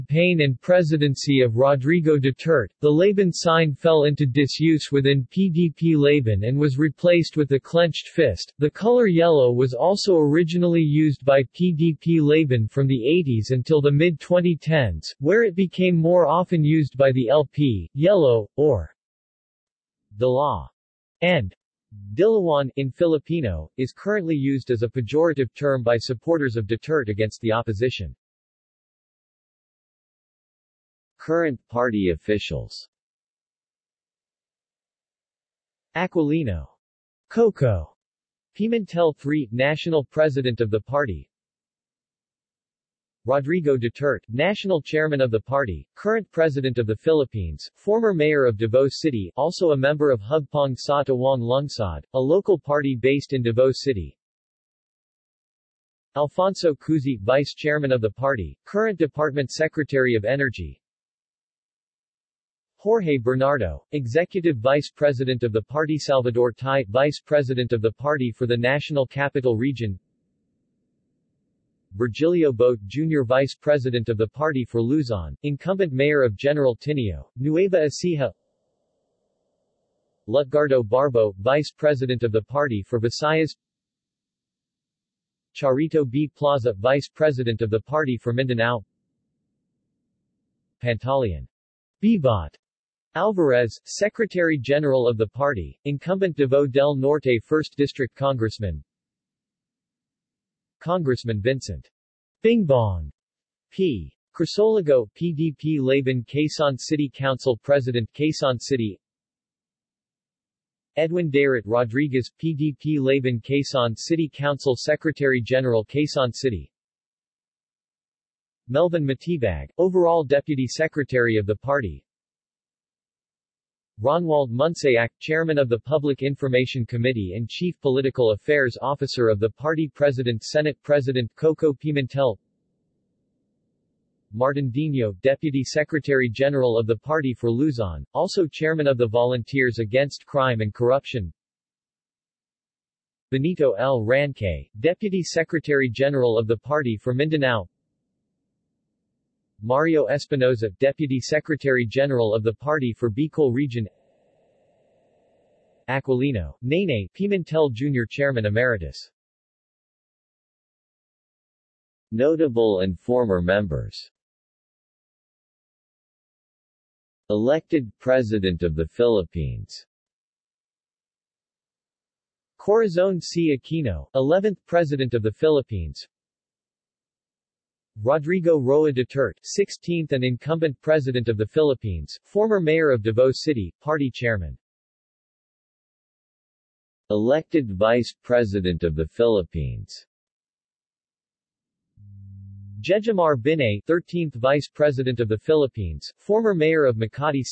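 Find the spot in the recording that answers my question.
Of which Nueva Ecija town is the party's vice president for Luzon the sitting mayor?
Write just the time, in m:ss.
1:16.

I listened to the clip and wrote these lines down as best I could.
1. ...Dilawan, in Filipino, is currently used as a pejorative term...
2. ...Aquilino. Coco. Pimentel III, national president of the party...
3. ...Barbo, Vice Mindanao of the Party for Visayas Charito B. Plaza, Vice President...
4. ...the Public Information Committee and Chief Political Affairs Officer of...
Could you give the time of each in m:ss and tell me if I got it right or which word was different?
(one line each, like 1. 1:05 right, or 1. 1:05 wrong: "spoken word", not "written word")
1. 0:22 right
2. 0:35 right
3. 1:20 wrong: "President", not "Mindanao"
4. 2:05 right.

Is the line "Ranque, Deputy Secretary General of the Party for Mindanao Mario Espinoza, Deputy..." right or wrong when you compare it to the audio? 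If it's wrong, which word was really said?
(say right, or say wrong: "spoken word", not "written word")
right.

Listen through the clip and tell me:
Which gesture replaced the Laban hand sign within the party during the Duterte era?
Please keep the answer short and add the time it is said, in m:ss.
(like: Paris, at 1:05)
clenched fist, at 0:07.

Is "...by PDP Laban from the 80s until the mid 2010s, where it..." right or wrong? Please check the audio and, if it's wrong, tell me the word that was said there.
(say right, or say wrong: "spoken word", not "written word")
right.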